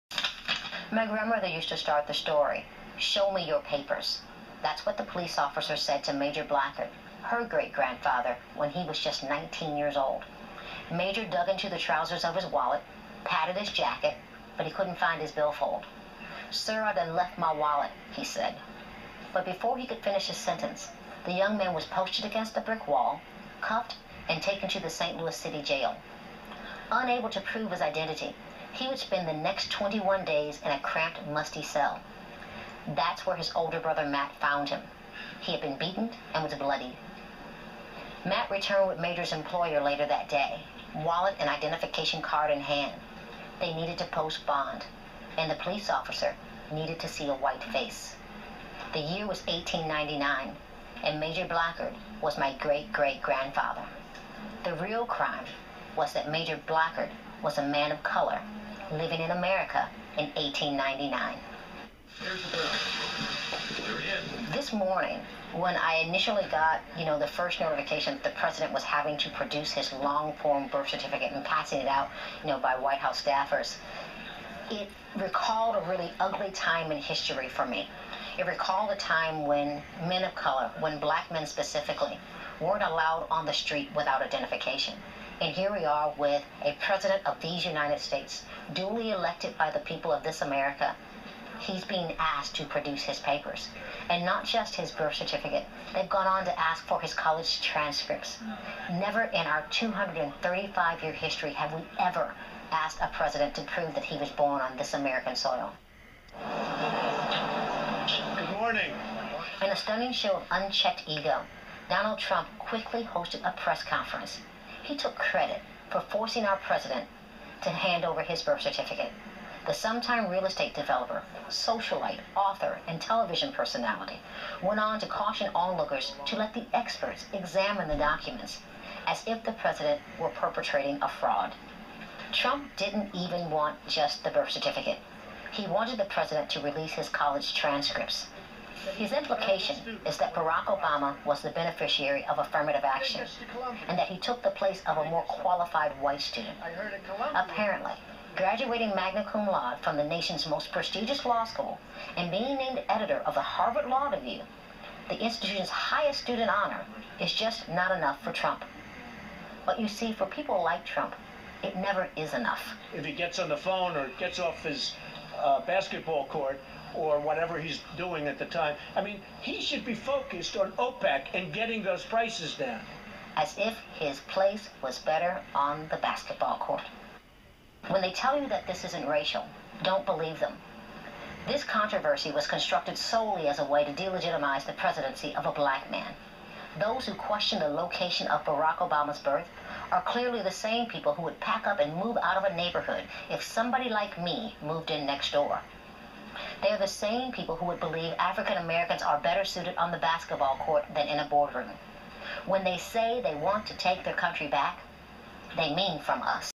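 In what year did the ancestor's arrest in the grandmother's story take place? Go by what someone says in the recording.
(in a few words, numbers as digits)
1899.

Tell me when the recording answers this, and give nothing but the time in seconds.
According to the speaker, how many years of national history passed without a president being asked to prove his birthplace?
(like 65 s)
99 s.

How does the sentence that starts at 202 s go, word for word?
When they say they want to take their country back, they mean from us.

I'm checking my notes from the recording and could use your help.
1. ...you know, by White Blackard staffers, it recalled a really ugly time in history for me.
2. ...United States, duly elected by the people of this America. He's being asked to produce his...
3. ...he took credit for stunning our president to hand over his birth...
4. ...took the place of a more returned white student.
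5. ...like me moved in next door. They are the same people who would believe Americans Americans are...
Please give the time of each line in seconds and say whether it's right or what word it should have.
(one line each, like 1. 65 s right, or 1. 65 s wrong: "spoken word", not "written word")
1. 72 s wrong: "House", not "Blackard"
2. 87 s right
3. 114 s wrong: "forcing", not "stunning"
4. 144 s wrong: "qualified", not "returned"
5. 193 s wrong: "African", not "Americans".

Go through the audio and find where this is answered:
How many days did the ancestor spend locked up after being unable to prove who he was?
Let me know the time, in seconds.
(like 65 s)
29 s.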